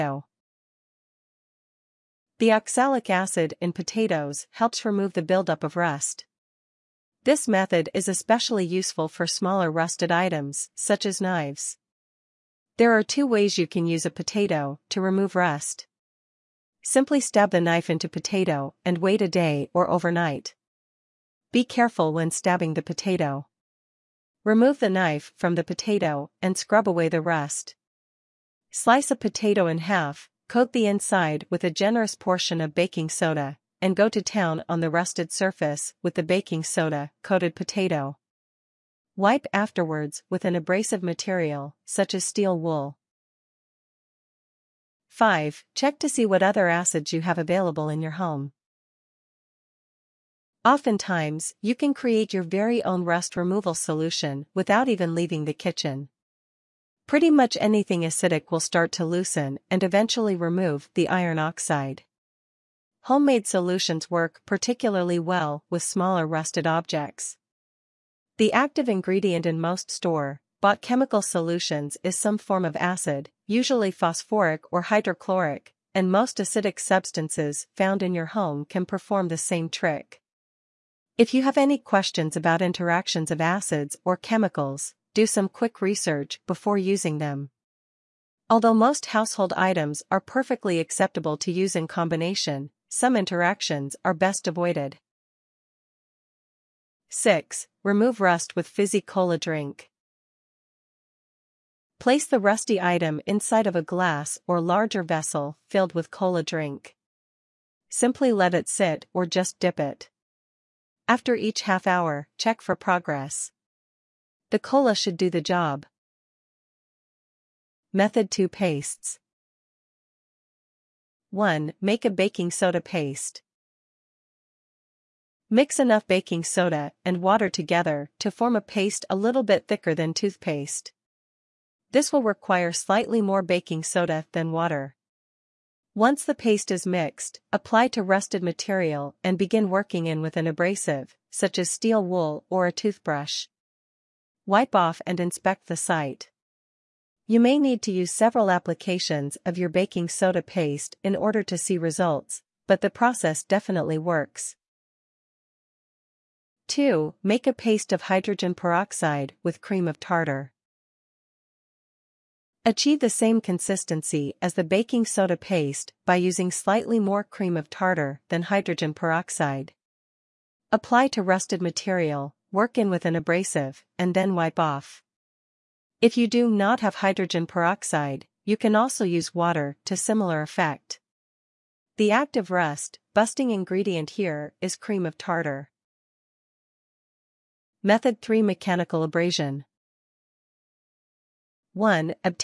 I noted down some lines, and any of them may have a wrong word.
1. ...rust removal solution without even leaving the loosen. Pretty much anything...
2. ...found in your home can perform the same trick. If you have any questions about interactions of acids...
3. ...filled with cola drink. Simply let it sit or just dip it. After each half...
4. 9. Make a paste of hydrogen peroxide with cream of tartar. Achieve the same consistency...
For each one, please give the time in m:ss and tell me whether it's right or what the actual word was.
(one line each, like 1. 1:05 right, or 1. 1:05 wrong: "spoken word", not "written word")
1. 0:53 wrong: "kitchen", not "loosen"
2. 1:17 right
3. 1:45 right
4. 2:36 wrong: "2", not "9".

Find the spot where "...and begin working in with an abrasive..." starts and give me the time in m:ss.
2:19.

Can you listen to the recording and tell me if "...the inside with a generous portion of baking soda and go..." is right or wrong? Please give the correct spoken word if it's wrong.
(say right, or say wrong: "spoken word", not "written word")
right.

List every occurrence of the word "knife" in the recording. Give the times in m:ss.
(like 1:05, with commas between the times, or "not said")
0:17, 0:24.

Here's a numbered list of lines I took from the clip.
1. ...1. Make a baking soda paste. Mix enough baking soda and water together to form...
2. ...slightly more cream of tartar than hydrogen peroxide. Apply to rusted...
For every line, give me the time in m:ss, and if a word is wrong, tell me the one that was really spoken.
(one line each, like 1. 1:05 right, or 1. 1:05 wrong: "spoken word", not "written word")
1. 2:01 right
2. 2:46 right.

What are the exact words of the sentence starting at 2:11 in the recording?
This will require slightly more baking soda than water.